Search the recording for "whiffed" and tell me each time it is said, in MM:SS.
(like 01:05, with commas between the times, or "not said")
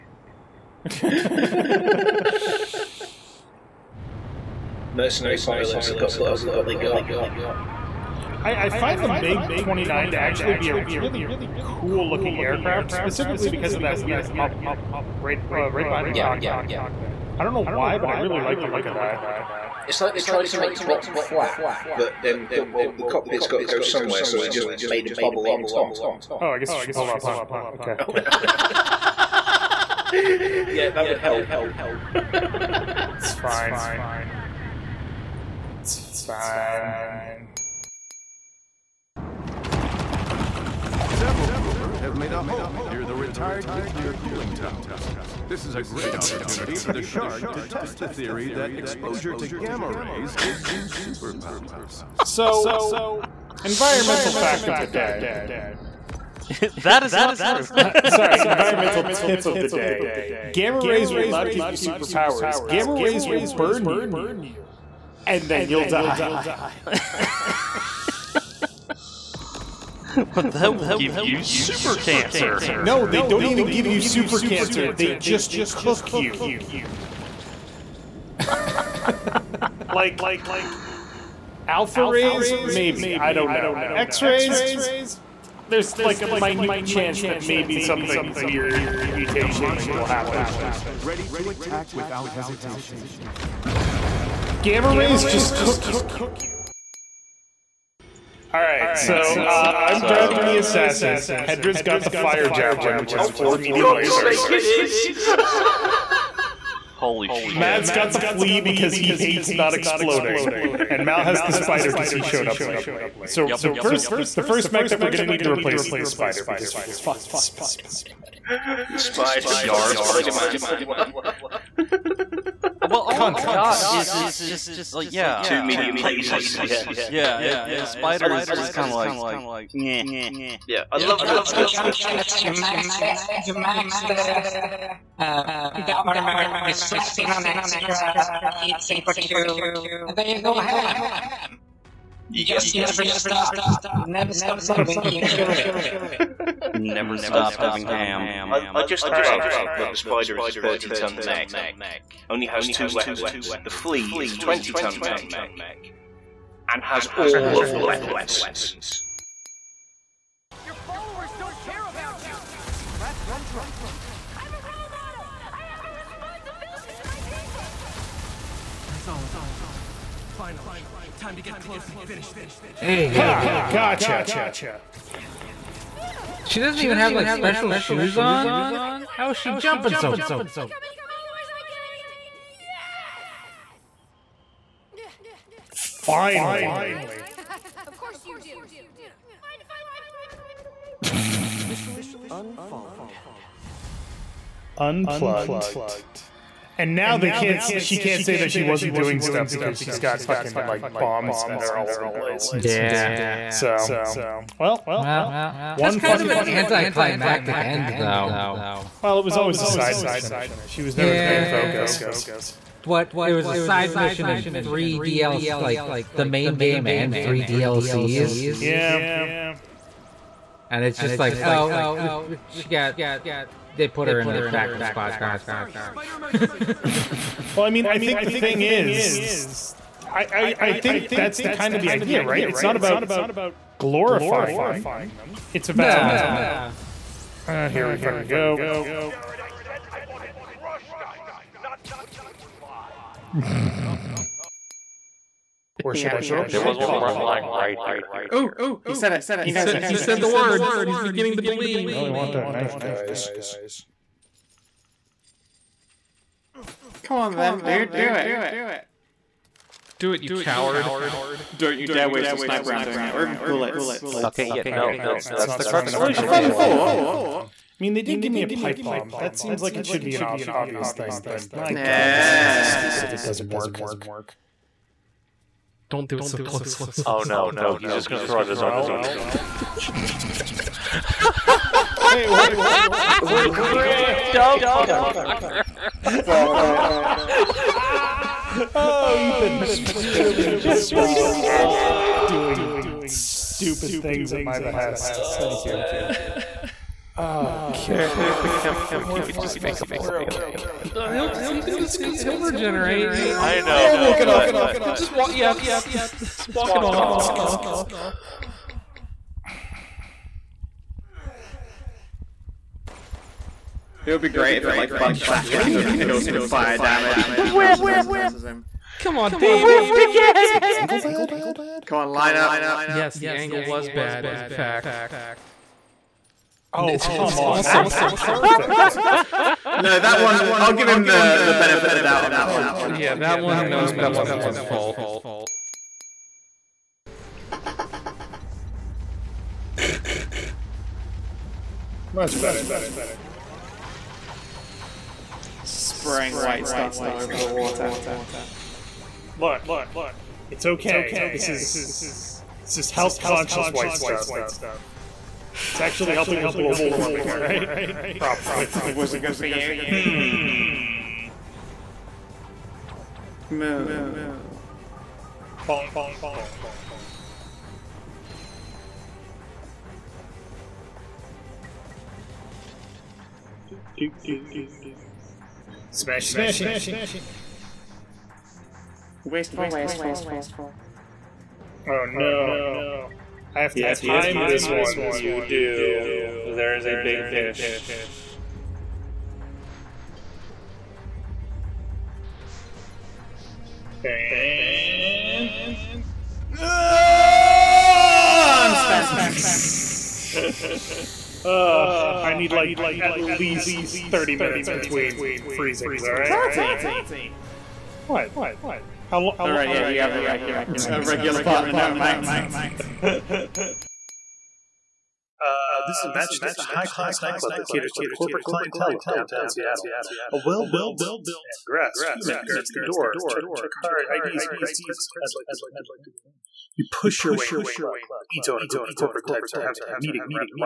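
05:19.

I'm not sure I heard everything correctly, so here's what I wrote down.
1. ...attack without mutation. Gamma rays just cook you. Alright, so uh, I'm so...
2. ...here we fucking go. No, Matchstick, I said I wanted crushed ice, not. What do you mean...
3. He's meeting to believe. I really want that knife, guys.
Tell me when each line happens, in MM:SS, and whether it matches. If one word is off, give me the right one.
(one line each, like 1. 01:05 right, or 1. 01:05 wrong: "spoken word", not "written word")
1. 01:31 wrong: "hesitation", not "mutation"
2. 03:57 wrong: "Jared", not "Matchstick"
3. 04:10 wrong: "beginning", not "meeting".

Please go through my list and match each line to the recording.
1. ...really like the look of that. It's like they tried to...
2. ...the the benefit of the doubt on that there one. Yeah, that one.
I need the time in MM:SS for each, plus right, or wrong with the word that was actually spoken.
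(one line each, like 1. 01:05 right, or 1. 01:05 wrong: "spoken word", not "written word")
1. 00:18 right
2. 05:31 right.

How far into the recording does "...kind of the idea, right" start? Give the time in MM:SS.
03:51.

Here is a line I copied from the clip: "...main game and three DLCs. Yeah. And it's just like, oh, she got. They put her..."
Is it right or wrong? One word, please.
right.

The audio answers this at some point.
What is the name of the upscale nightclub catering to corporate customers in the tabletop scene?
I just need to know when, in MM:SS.
06:56.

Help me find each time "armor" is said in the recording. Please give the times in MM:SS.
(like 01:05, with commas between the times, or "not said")
02:15.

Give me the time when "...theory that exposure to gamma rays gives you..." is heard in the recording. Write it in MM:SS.
00:48.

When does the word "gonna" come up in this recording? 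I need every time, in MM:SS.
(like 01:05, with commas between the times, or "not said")
01:55, 04:38.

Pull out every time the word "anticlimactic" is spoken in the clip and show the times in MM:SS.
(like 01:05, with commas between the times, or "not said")
03:26.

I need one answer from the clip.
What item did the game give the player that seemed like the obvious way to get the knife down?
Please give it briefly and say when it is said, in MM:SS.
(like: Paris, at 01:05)
a pipe bomb, at 04:28.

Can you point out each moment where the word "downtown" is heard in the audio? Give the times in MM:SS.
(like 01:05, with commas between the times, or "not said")
06:59.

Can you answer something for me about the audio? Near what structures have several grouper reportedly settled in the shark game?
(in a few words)
retired nuclear cooling towers.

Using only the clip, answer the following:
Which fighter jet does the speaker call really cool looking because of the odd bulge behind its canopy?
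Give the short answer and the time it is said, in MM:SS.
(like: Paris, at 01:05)
MiG 29, at 00:09.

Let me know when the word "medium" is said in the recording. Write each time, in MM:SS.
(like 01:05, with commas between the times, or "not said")
01:43, 02:05.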